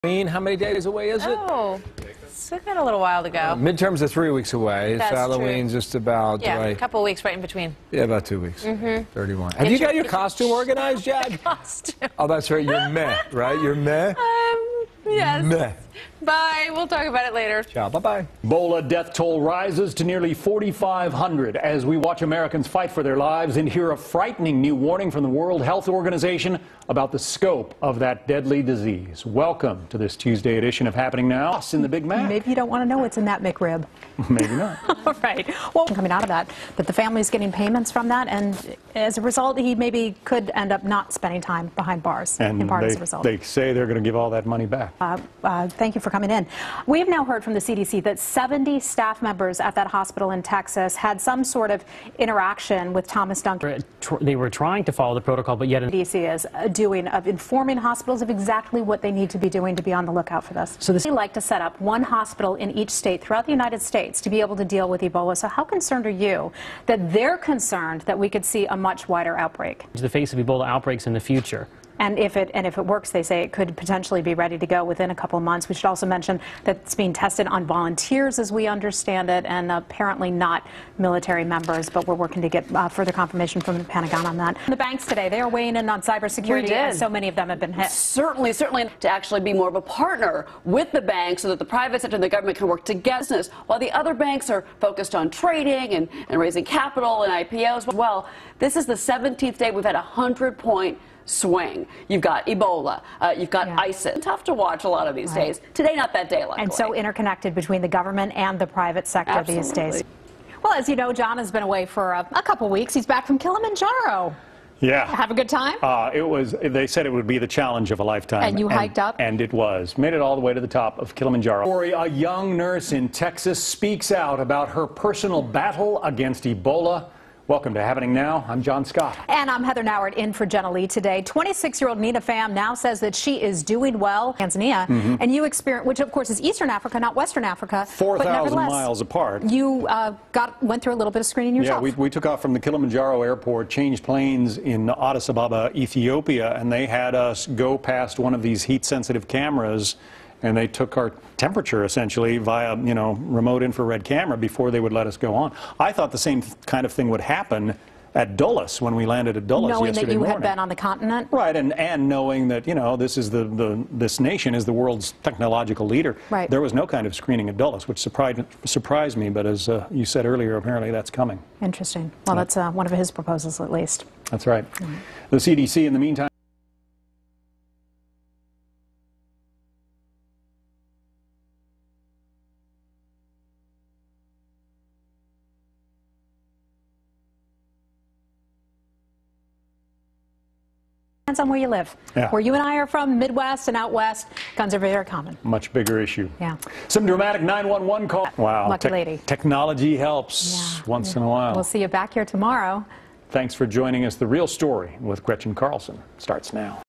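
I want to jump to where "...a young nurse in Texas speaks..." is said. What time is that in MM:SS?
02:01.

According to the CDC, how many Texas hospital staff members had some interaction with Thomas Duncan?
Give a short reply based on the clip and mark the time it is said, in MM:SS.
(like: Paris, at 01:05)
70, at 00:48.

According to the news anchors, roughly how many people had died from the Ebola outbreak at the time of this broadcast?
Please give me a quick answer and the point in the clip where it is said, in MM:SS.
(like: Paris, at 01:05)
4,500, at 00:20.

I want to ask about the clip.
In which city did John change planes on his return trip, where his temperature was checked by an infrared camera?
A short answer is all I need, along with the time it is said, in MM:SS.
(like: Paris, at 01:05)
Addis Ababa, at 02:24.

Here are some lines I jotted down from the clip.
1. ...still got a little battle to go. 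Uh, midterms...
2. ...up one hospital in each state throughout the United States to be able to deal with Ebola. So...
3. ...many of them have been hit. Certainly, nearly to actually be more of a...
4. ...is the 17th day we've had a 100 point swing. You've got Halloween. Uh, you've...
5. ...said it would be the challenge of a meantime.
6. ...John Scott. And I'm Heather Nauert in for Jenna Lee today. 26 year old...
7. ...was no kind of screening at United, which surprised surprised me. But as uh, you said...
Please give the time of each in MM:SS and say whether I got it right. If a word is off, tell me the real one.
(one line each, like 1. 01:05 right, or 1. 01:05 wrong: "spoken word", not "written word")
1. 00:02 wrong: "while", not "battle"
2. 01:01 right
3. 01:27 wrong: "certainly", not "nearly"
4. 01:38 wrong: "Ebola", not "Halloween"
5. 01:56 wrong: "lifetime", not "meantime"
6. 02:08 right
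7. 02:46 wrong: "Dulles", not "United".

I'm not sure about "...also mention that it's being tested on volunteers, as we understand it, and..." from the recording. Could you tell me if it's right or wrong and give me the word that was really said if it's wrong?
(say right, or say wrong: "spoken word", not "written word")
right.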